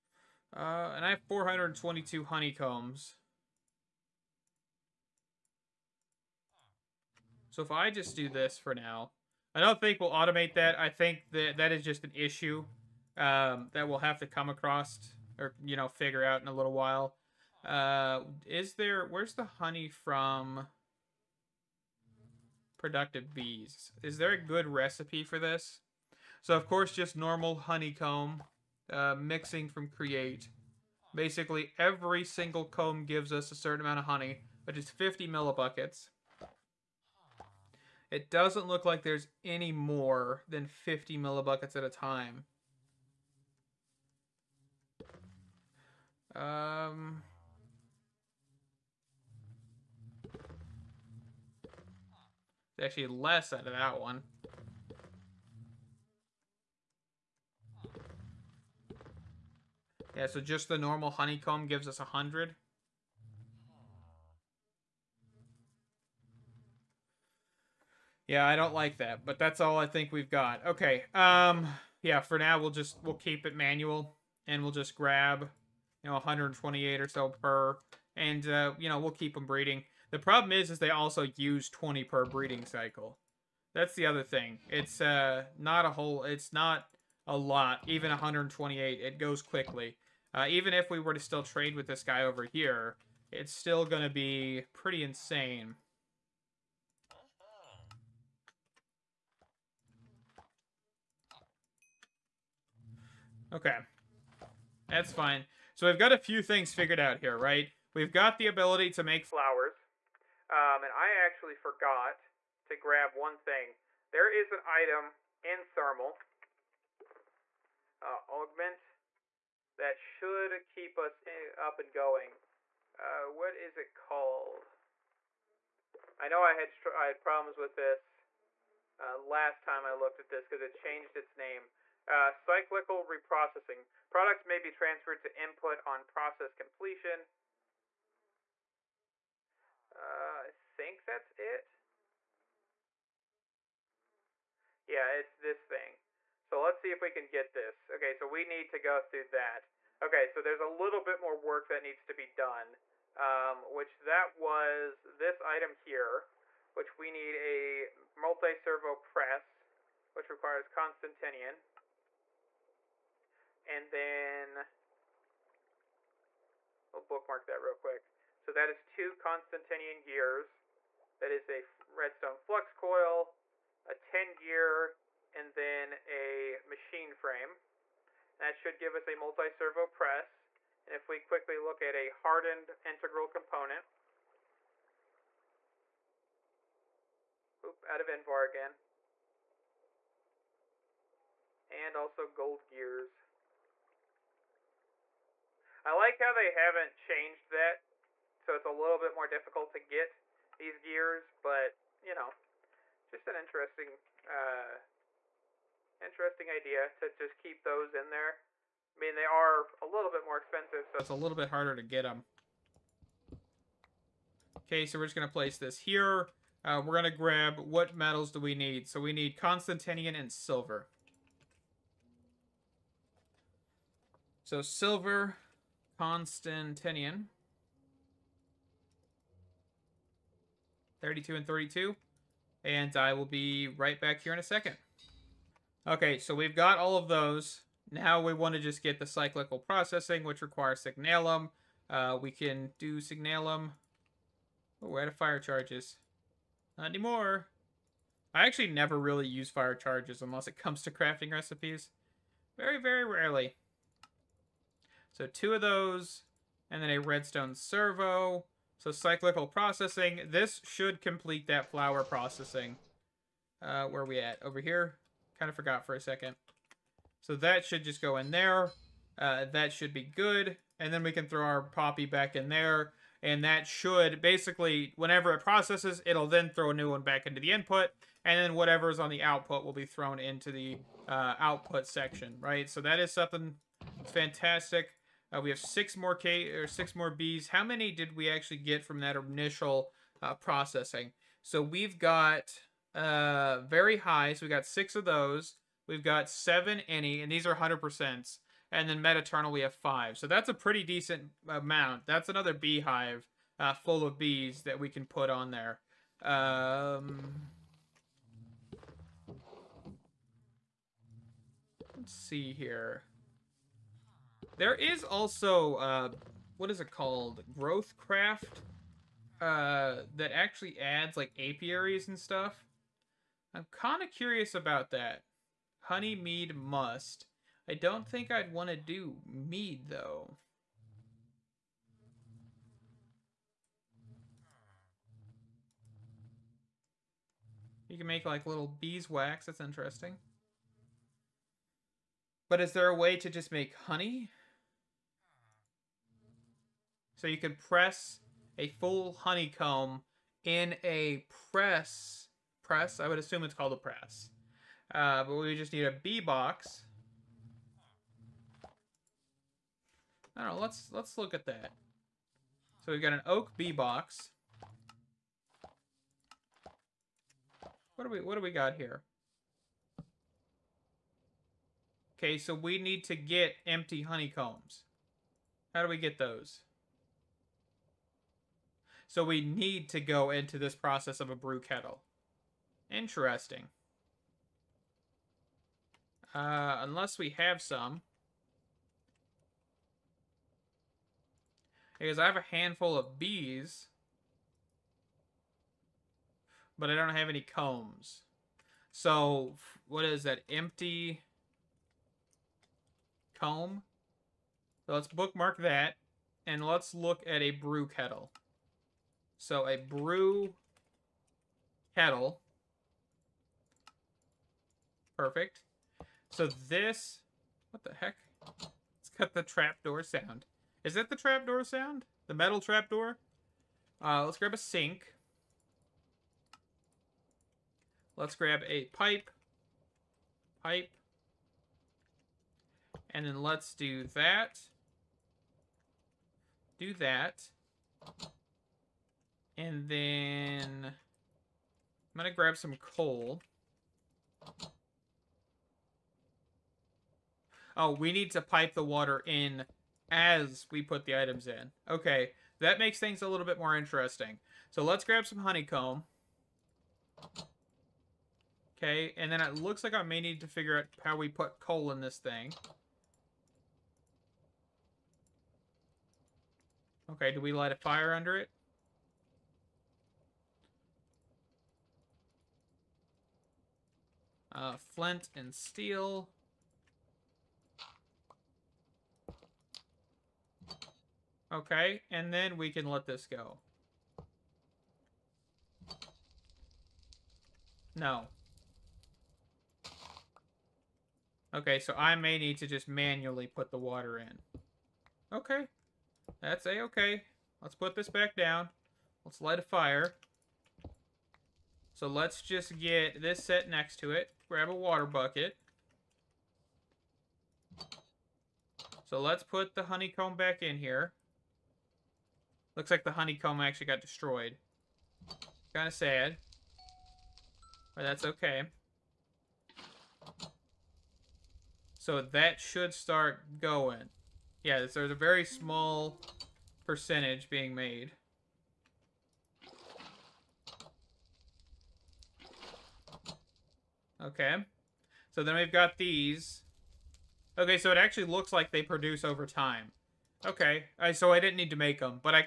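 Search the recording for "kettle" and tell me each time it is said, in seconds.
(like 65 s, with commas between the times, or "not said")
381 s, 407 s, 411 s.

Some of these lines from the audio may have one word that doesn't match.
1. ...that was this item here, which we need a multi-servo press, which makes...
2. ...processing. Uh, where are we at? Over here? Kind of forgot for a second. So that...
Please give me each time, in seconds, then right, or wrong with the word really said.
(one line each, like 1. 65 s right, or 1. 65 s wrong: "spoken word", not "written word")
1. 153 s wrong: "requires", not "makes"
2. 262 s right.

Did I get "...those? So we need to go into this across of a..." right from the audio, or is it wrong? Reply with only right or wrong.
wrong.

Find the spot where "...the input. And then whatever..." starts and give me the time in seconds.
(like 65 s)
277 s.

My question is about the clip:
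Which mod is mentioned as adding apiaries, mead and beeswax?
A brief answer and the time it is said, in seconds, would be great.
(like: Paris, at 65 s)
Growthcraft, at 317 s.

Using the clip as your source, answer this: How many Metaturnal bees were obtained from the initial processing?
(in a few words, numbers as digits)
5.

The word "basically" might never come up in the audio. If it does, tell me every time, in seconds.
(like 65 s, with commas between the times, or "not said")
31 s, 274 s.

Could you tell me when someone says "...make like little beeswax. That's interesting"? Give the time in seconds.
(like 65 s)
338 s.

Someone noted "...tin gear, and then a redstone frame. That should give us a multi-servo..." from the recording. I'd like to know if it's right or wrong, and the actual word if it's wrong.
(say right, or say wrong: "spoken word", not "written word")
wrong: "machine", not "redstone".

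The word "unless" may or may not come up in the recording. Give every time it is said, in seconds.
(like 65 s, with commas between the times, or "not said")
250 s, 386 s.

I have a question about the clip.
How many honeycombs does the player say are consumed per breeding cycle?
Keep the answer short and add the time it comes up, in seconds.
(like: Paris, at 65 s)
20, at 81 s.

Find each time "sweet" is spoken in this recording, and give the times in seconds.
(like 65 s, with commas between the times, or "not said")
not said.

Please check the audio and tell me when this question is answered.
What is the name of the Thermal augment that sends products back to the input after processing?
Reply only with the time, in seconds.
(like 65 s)
132 s.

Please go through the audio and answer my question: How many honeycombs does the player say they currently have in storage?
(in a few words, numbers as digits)
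422.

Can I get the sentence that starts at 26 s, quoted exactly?
So of course, just normal honeycomb uh, mixing from create.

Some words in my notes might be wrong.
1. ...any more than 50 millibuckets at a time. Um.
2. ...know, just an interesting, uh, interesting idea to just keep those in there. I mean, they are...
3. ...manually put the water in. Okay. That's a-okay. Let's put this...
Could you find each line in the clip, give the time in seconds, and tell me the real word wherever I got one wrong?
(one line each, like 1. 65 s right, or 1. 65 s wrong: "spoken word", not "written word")
1. 39 s right
2. 202 s right
3. 492 s right.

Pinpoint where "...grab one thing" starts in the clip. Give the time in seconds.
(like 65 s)
112 s.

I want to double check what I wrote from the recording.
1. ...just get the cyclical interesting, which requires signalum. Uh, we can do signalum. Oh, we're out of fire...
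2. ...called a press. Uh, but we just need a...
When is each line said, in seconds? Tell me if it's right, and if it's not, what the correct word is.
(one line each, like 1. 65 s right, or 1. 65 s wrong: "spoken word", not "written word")
1. 238 s wrong: "processing", not "interesting"
2. 353 s right.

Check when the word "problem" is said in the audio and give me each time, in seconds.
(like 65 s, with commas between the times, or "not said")
80 s, 127 s.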